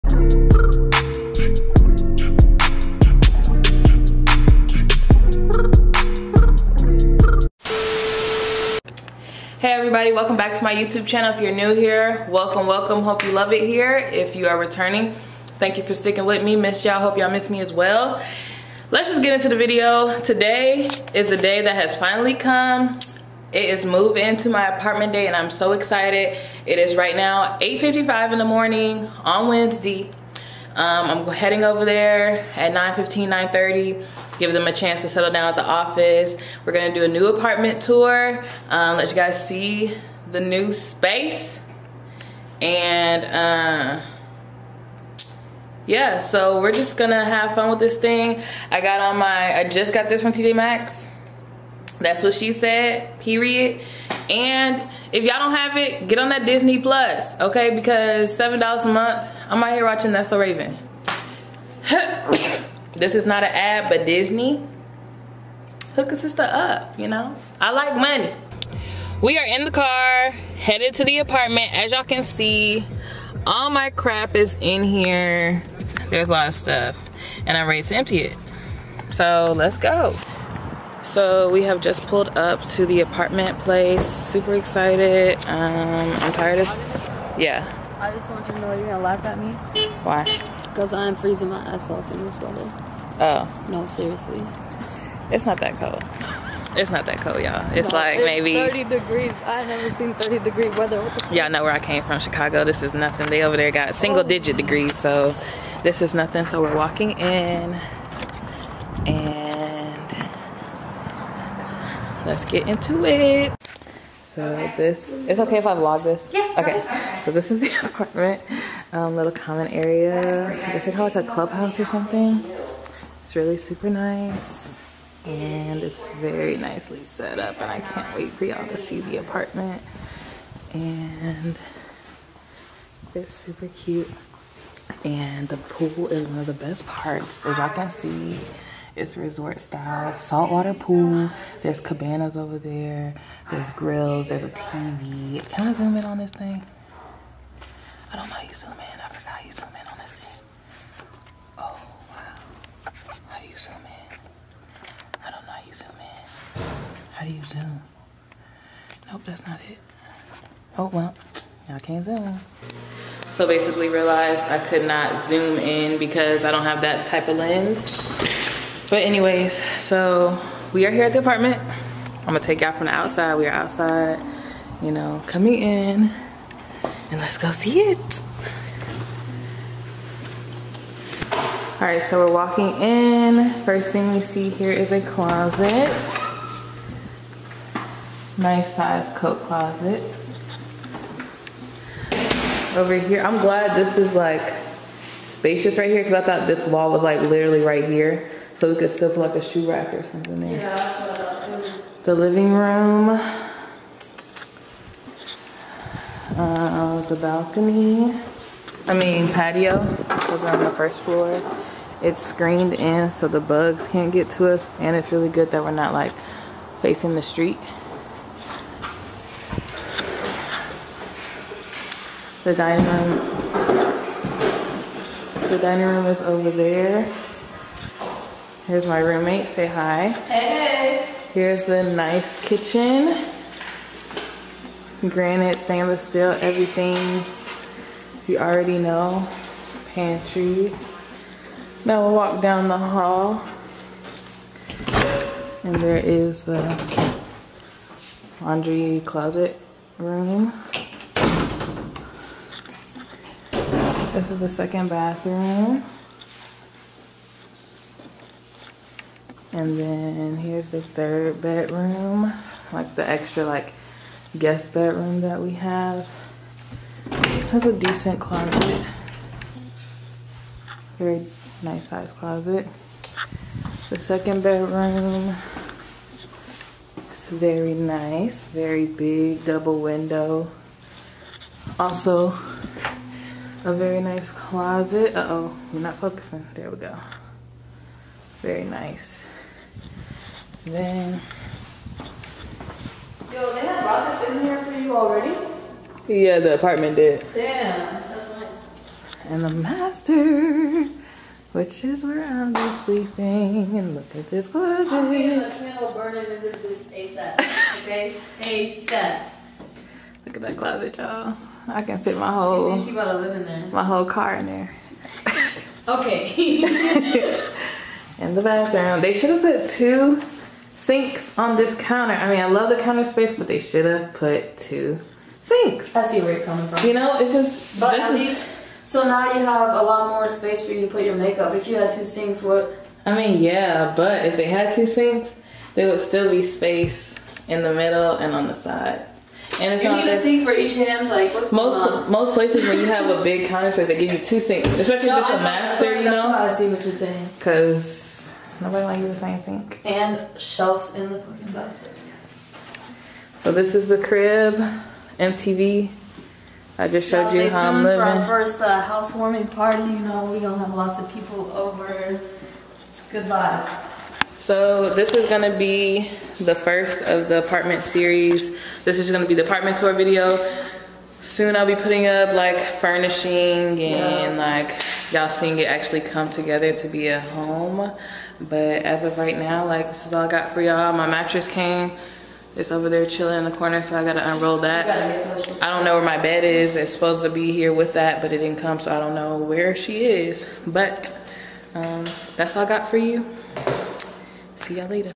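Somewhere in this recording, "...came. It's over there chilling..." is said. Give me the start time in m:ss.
6:21.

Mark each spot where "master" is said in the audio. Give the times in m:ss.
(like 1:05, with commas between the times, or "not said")
4:59, 5:45.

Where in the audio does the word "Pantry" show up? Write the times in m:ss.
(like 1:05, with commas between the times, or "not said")
3:59.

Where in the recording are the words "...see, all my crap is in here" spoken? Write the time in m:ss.
1:12.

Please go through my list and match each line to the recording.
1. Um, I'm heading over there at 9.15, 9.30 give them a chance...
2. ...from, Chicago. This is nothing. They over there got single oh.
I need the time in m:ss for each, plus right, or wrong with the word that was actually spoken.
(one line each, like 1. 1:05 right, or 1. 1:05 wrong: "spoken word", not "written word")
1. 0:30 right
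2. 1:42 right.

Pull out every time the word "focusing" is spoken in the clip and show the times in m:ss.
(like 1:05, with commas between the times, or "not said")
4:45.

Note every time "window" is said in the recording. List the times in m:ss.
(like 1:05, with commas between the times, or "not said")
4:39.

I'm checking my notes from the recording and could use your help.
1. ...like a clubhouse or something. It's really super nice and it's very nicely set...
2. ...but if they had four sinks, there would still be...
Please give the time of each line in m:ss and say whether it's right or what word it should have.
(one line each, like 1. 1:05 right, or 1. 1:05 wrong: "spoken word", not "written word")
1. 2:01 right
2. 5:33 wrong: "two", not "four".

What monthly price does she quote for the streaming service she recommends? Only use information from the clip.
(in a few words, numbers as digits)
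$7.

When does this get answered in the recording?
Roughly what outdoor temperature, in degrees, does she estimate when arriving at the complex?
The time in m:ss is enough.
1:38.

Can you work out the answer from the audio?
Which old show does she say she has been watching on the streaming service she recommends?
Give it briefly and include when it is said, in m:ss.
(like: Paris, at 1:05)
That's So Raven, at 1:00.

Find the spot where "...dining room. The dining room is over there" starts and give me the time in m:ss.
3:42.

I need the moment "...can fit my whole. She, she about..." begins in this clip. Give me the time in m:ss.
5:11.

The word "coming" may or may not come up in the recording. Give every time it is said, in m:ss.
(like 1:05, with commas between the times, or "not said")
2:55, 5:26.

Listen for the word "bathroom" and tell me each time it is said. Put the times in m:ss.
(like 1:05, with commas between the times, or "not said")
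4:14, 5:18, 5:51.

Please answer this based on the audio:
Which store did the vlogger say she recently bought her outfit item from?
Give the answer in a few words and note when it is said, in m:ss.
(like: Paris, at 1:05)
TJ Maxx, at 0:50.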